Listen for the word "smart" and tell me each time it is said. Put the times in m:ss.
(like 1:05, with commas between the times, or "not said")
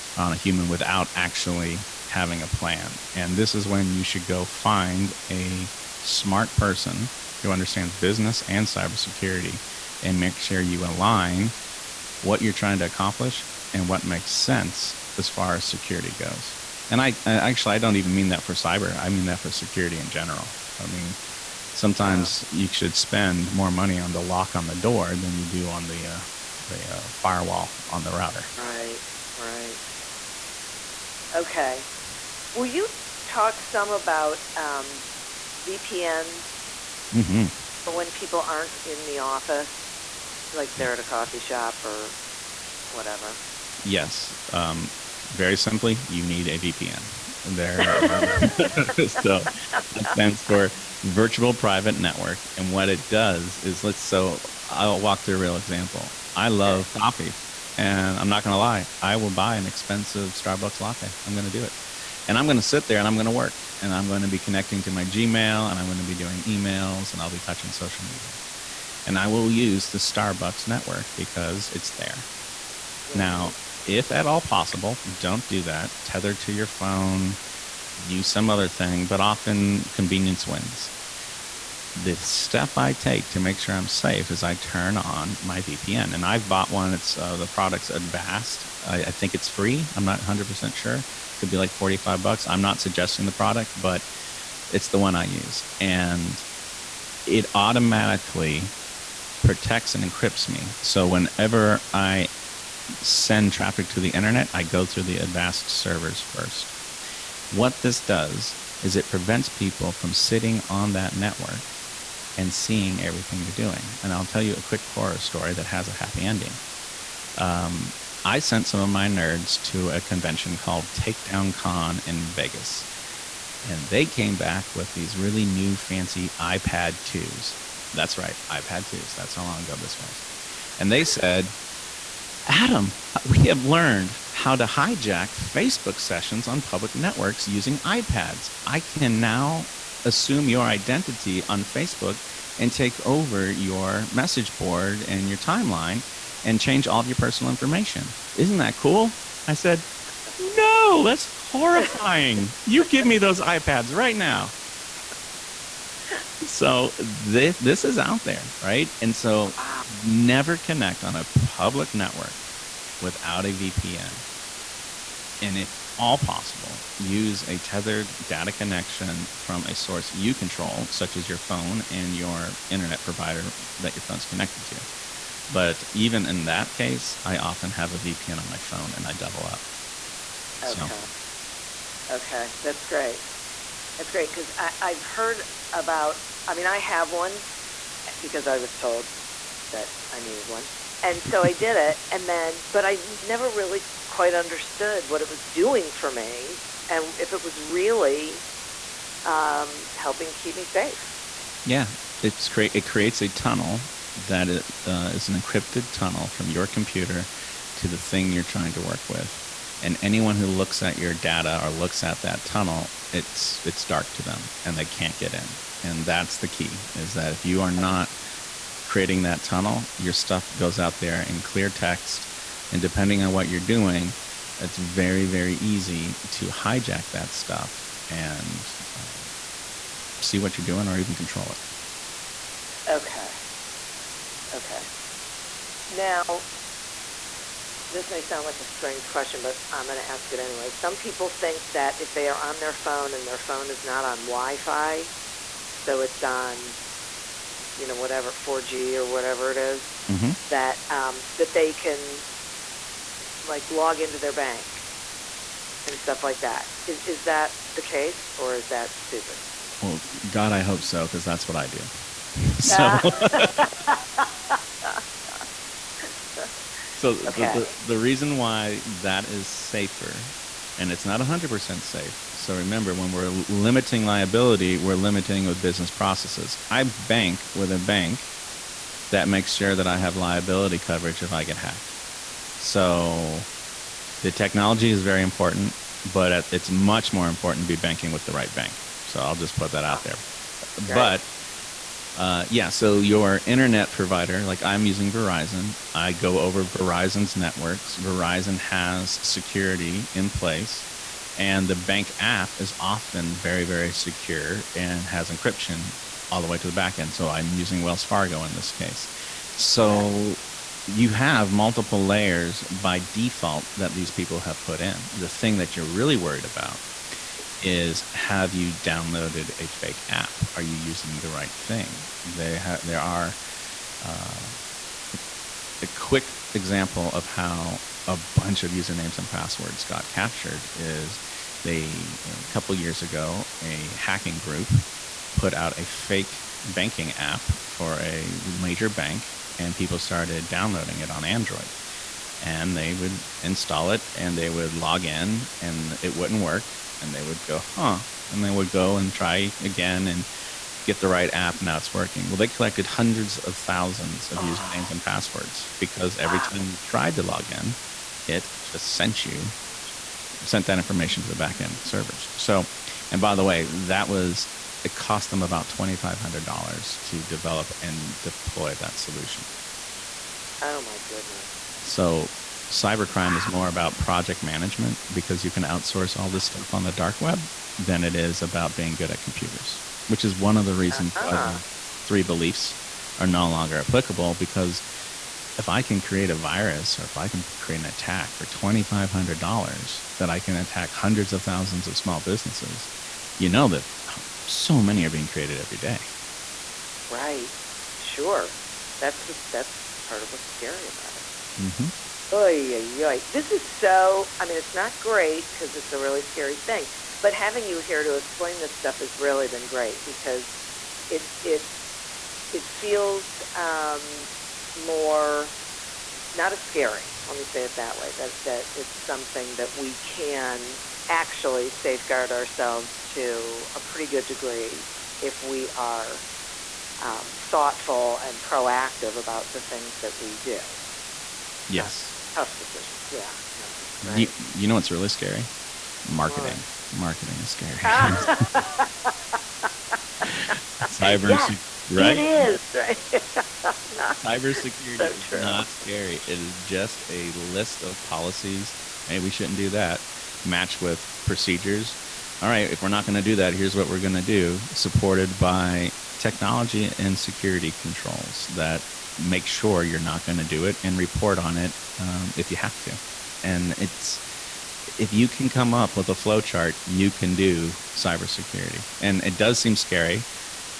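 0:05.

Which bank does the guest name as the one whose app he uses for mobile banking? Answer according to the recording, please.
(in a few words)
Wells Fargo.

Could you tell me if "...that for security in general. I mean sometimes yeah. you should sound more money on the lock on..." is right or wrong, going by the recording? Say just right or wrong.
wrong.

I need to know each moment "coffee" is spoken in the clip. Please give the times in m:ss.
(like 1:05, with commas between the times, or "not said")
0:41, 0:56.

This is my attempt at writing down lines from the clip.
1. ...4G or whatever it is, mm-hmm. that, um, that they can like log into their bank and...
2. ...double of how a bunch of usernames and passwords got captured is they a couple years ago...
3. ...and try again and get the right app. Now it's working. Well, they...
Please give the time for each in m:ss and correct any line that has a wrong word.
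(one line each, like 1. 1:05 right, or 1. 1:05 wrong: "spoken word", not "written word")
1. 4:08 right
2. 5:26 wrong: "example", not "double"
3. 5:48 right.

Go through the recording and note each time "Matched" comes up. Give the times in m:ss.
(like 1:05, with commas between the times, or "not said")
7:30.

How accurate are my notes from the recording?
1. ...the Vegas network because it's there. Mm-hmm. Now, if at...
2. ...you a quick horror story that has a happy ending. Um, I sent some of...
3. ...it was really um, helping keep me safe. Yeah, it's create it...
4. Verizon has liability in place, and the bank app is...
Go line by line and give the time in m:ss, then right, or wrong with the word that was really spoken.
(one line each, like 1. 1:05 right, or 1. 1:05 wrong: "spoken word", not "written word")
1. 1:09 wrong: "Starbucks", not "Vegas"
2. 1:54 right
3. 3:17 right
4. 4:57 wrong: "security", not "liability".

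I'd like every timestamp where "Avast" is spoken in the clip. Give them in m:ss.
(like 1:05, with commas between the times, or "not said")
1:27, 1:45.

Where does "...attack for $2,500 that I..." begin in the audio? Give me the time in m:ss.
6:27.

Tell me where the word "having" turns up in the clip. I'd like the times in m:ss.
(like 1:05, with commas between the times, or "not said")
0:02, 6:47.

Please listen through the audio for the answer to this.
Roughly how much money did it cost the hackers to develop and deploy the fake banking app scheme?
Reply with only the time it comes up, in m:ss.
6:05.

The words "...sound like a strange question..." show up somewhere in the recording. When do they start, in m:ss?
3:58.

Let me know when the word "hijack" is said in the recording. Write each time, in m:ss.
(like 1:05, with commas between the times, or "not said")
2:14, 3:46.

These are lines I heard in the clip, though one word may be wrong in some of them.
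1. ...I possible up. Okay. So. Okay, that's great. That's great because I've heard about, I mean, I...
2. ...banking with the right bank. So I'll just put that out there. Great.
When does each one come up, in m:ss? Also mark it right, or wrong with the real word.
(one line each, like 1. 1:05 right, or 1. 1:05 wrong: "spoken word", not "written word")
1. 2:59 wrong: "double", not "possible"
2. 4:47 right.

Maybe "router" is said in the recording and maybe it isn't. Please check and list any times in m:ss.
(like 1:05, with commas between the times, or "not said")
0:28.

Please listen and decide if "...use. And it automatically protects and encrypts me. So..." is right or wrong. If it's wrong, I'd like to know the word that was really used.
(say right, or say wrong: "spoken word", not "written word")
right.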